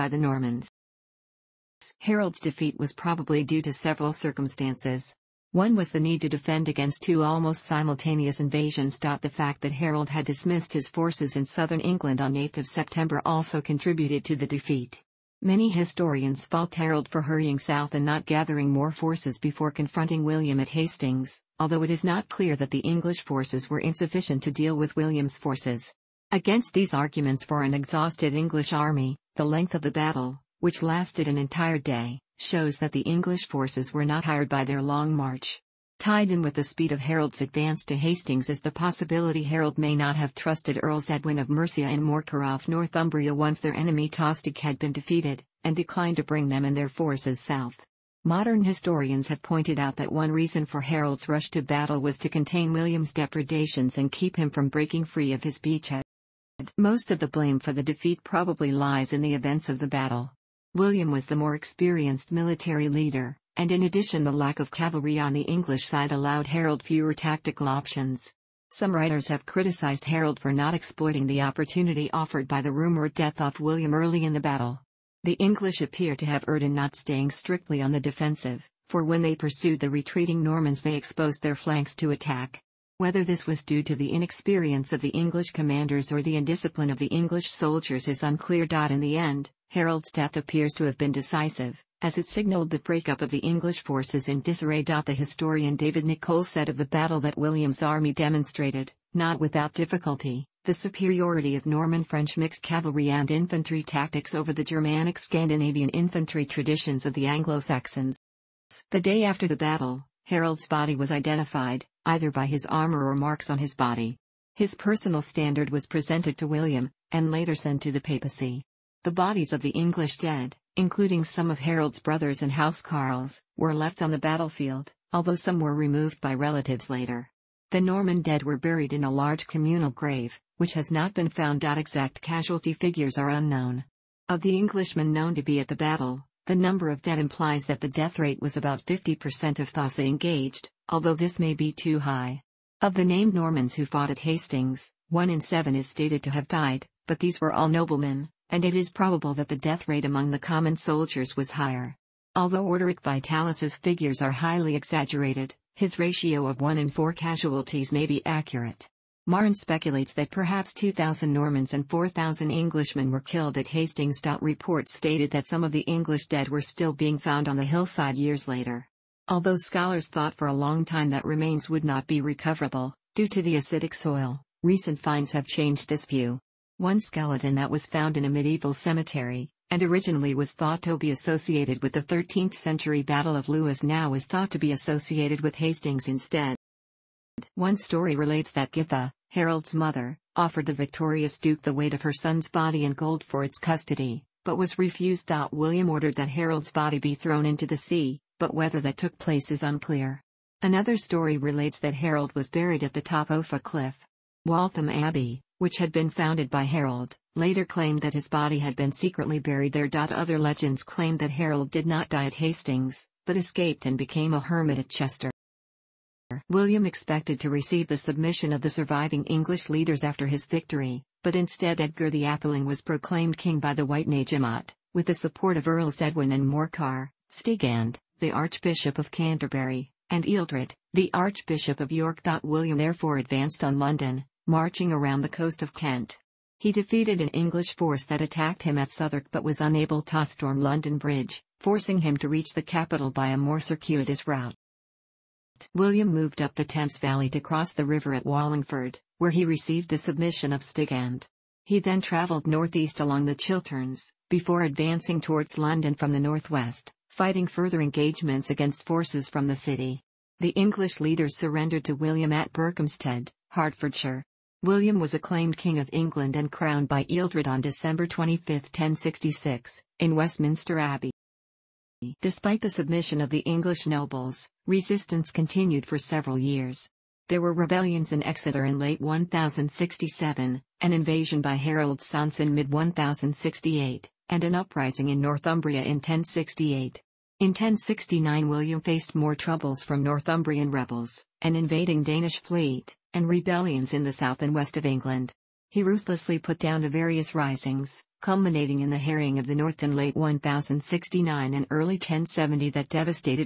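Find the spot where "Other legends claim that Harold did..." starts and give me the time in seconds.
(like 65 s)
209 s.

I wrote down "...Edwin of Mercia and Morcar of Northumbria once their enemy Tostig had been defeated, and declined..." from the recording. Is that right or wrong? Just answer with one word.
right.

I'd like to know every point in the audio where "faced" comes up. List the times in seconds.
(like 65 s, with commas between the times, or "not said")
288 s.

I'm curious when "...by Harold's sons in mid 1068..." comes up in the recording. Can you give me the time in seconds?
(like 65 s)
281 s.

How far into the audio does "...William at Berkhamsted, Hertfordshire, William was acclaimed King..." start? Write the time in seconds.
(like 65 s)
261 s.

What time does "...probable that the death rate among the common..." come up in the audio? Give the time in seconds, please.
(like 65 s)
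148 s.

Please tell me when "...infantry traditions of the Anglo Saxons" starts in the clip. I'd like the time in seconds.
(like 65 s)
105 s.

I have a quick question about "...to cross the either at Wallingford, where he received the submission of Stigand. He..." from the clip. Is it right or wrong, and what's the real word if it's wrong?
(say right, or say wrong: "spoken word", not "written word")
wrong: "river", not "either".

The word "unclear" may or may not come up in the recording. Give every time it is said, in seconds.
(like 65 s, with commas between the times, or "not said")
88 s, 199 s.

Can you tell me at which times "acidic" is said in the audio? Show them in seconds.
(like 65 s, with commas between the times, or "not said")
173 s.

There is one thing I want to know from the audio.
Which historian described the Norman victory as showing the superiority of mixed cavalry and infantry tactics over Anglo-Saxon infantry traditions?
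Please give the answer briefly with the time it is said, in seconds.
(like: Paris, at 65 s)
David Nicolle, at 95 s.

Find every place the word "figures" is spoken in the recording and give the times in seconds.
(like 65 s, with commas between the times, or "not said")
132 s, 153 s.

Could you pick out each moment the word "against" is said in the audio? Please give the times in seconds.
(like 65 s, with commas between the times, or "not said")
6 s, 26 s, 258 s.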